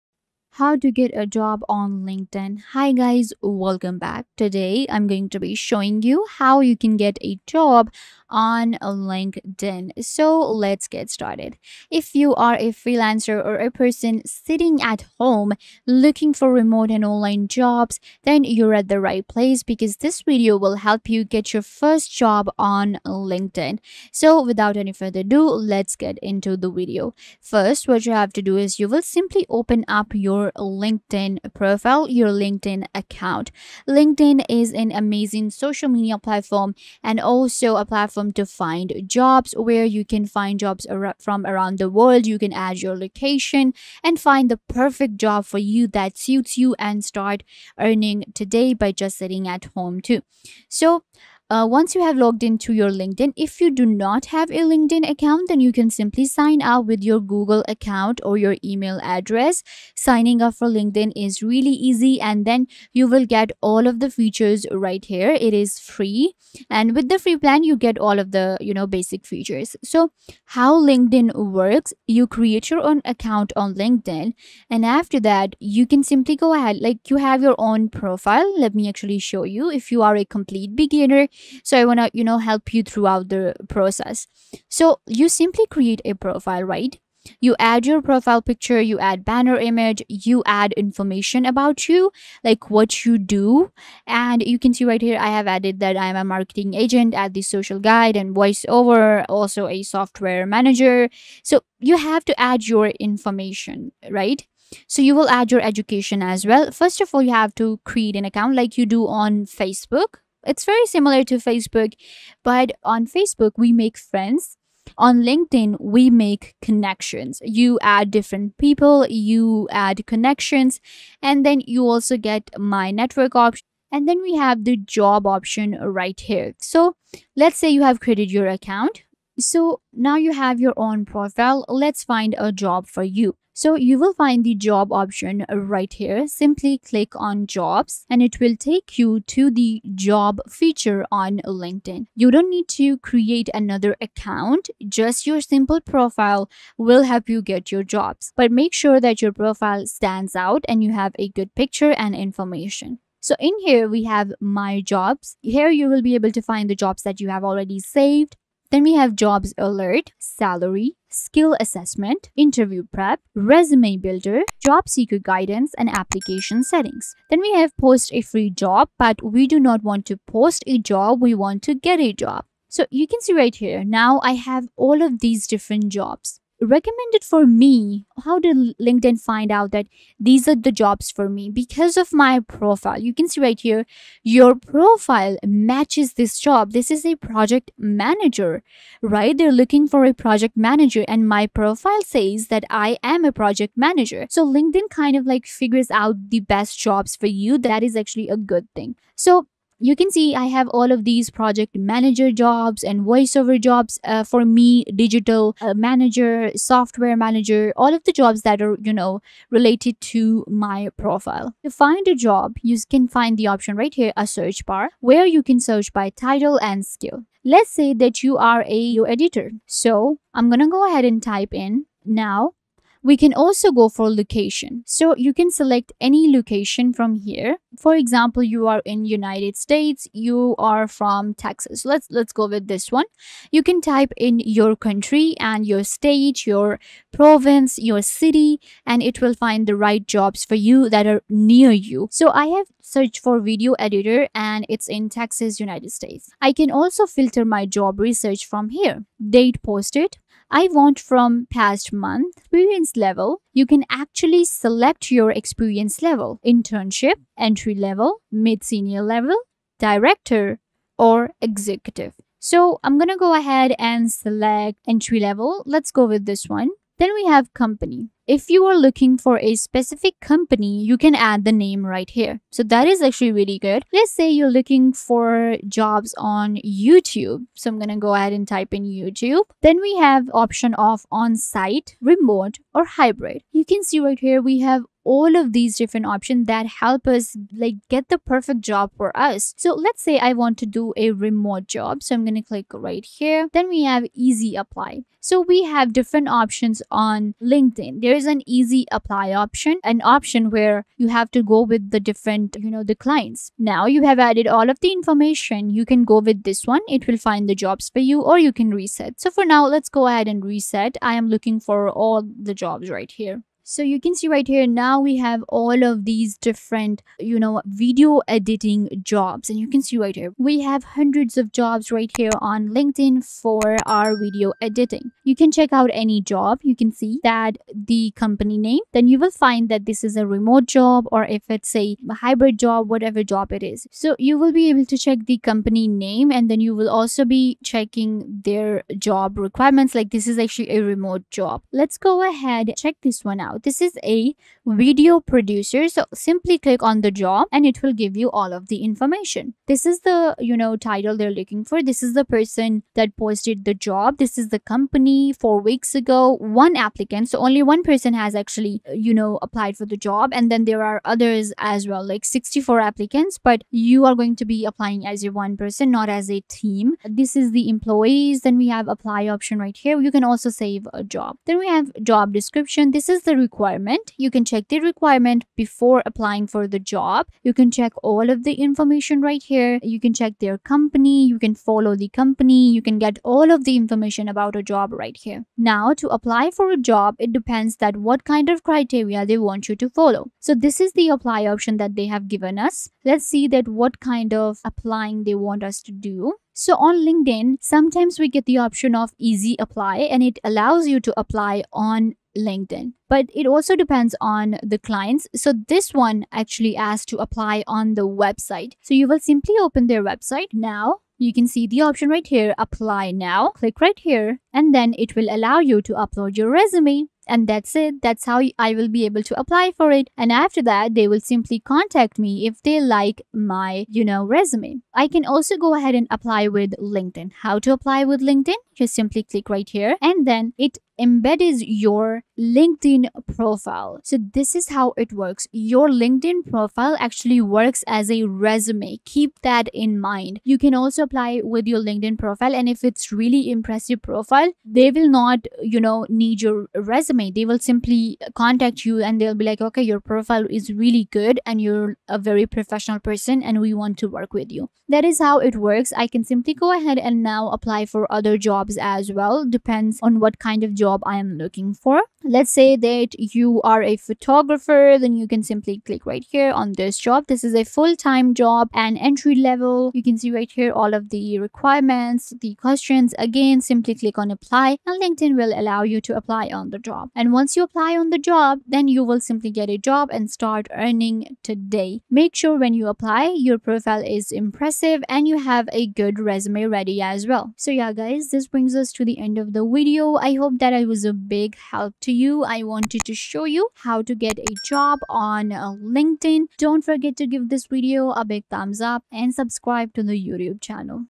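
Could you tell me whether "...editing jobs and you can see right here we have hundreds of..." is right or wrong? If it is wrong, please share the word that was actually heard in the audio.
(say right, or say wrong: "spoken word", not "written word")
right.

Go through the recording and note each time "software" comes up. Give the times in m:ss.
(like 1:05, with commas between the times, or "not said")
1:39, 3:26.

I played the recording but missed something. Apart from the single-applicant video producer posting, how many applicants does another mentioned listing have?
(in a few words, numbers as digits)
64.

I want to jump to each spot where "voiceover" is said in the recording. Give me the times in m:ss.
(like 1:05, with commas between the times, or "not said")
1:38, 3:23.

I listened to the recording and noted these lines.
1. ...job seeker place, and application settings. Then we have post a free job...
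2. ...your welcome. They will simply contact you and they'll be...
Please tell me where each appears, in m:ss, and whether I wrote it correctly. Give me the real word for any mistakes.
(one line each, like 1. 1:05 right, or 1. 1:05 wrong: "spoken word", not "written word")
1. 2:44 wrong: "guidance", not "place"
2. 7:26 wrong: "resume", not "welcome".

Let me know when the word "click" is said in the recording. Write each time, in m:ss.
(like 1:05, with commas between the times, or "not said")
2:16, 4:52, 5:46, 6:53, 7:09, 7:45, 7:53.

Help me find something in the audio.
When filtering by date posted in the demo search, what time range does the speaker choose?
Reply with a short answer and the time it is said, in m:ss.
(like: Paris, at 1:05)
Past month, at 4:11.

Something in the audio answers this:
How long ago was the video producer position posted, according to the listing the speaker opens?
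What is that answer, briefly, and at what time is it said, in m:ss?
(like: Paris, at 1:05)
Four weeks ago, at 5:55.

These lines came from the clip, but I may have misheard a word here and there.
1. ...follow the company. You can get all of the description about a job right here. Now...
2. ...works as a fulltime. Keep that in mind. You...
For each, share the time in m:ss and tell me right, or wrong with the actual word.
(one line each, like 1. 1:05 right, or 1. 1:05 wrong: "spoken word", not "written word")
1. 6:21 wrong: "information", not "description"
2. 7:17 wrong: "resume", not "fulltime".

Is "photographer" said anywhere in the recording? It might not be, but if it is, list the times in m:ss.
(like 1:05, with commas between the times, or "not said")
7:43.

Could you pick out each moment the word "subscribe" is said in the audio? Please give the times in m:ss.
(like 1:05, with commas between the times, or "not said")
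8:19.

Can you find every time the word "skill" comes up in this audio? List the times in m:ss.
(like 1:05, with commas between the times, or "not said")
2:41, 3:36.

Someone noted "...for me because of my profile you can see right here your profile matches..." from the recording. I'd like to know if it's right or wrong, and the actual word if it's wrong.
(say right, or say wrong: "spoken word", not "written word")
right.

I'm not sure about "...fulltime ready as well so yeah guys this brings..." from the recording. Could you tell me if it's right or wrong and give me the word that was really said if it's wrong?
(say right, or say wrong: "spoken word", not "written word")
wrong: "resume", not "fulltime".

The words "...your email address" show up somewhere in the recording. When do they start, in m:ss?
0:58.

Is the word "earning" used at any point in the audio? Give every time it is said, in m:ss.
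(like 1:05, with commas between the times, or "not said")
0:47, 8:00.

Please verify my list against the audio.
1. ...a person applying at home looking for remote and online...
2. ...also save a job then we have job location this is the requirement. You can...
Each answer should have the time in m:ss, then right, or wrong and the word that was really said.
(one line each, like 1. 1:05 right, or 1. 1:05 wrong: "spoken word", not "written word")
1. 0:13 wrong: "sitting", not "applying"
2. 6:10 wrong: "description", not "location".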